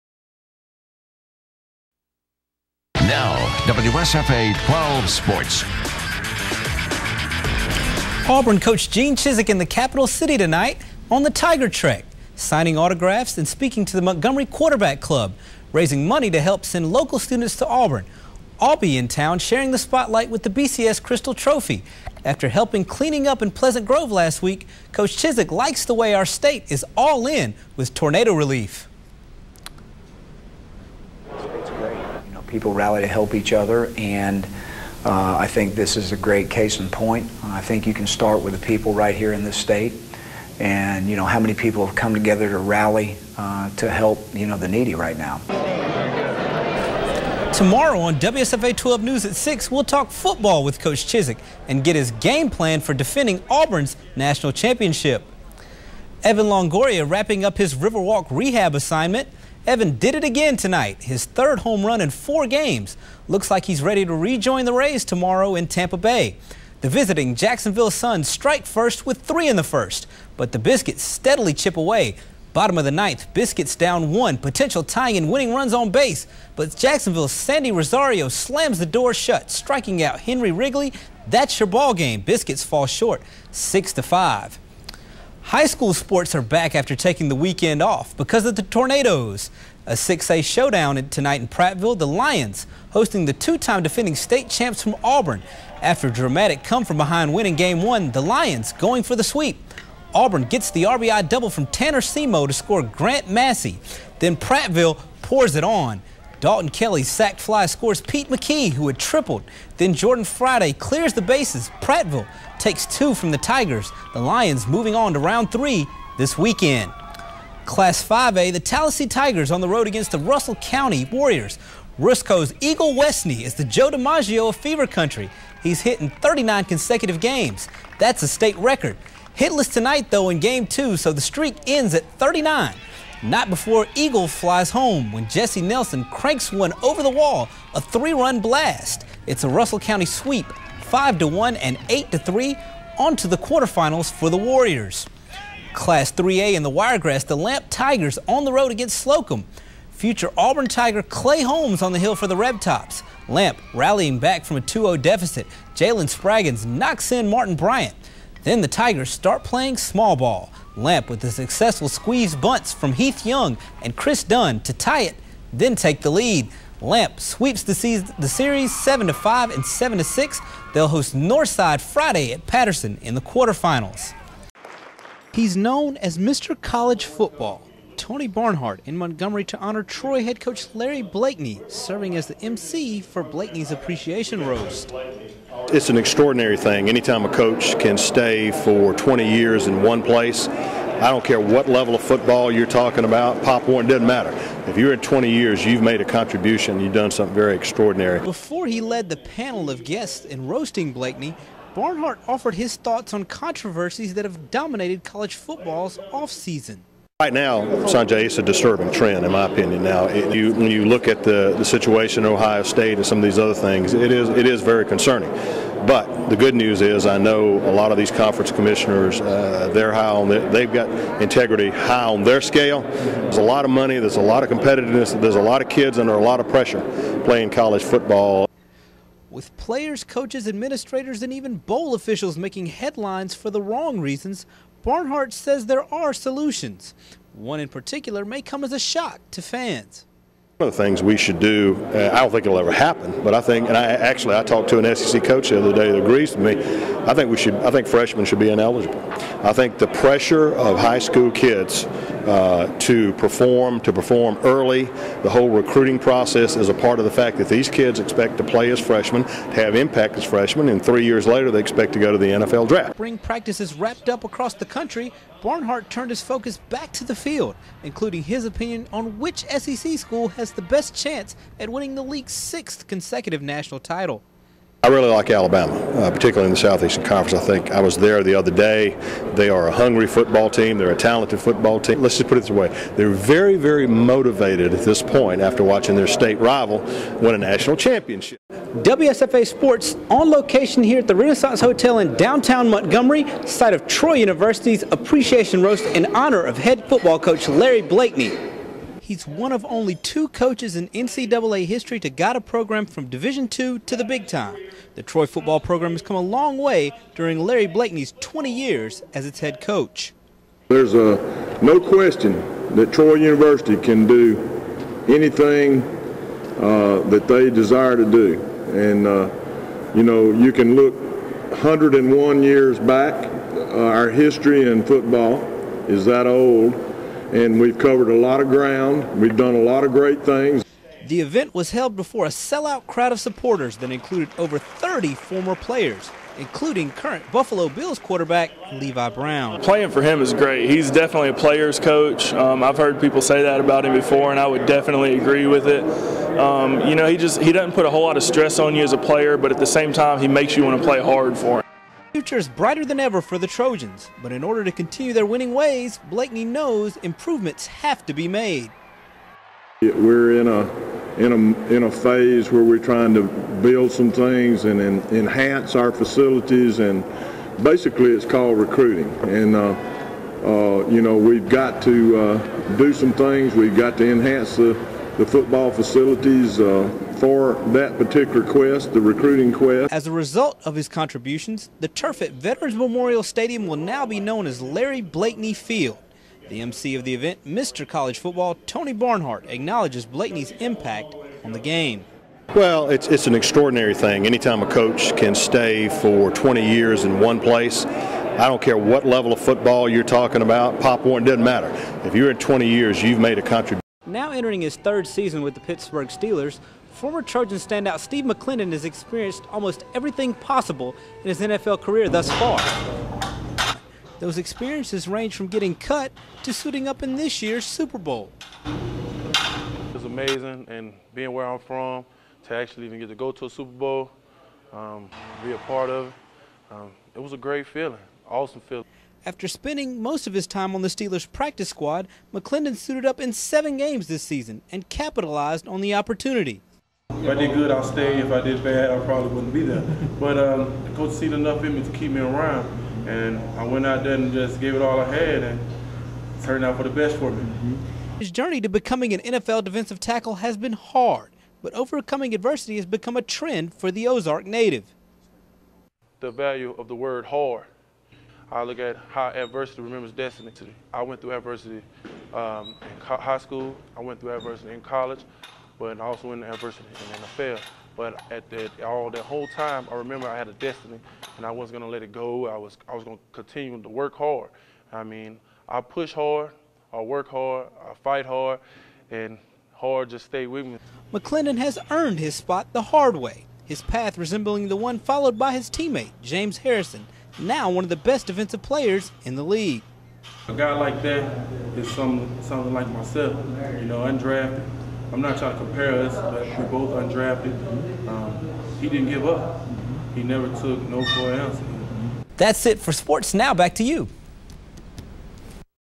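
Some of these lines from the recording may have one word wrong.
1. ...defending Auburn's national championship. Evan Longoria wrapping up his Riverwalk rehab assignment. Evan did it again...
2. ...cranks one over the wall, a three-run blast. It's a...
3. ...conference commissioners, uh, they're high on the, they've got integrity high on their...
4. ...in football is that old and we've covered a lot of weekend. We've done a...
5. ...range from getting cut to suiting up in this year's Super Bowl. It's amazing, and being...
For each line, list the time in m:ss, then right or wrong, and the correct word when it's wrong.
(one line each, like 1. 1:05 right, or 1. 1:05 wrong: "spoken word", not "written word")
1. 0:52 right
2. 2:16 right
3. 3:38 right
4. 5:24 wrong: "ground", not "weekend"
5. 6:55 right.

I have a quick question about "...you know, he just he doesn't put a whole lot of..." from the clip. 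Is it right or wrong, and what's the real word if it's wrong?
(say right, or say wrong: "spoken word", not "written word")
right.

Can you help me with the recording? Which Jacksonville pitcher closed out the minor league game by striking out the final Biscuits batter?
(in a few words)
Sandy Rosario.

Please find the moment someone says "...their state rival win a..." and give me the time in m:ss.
4:45.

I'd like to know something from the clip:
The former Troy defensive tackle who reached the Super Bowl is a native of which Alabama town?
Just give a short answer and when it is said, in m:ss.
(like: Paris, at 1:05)
Ozark, at 7:34.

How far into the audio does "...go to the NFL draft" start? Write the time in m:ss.
4:21.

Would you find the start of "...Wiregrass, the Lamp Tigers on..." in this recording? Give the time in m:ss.
2:26.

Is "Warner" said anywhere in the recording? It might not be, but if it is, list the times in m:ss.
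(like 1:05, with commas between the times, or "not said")
3:13, 6:41.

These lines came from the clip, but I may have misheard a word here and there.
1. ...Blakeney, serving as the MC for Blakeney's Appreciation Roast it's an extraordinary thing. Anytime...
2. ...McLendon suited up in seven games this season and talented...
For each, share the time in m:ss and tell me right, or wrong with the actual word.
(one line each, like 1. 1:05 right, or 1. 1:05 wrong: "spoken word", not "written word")
1. 3:01 right
2. 7:12 wrong: "capitalized", not "talented".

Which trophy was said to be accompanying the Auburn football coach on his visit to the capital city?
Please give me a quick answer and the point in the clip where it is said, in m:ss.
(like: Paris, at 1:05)
BCS Crystal Trophy, at 0:20.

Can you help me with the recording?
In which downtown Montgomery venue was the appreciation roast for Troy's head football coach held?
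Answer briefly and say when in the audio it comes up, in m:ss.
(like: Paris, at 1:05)
Renaissance Hotel, at 4:51.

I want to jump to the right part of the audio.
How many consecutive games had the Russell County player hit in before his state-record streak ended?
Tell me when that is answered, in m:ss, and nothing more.
2:06.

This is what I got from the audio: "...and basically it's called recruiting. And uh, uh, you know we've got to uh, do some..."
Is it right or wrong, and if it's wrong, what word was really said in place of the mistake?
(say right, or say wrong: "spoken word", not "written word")
right.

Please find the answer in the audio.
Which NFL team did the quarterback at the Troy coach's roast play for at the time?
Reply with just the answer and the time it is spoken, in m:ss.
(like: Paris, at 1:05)
Buffalo Bills, at 5:37.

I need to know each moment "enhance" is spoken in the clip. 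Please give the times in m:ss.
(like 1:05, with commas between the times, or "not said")
6:05, 6:14.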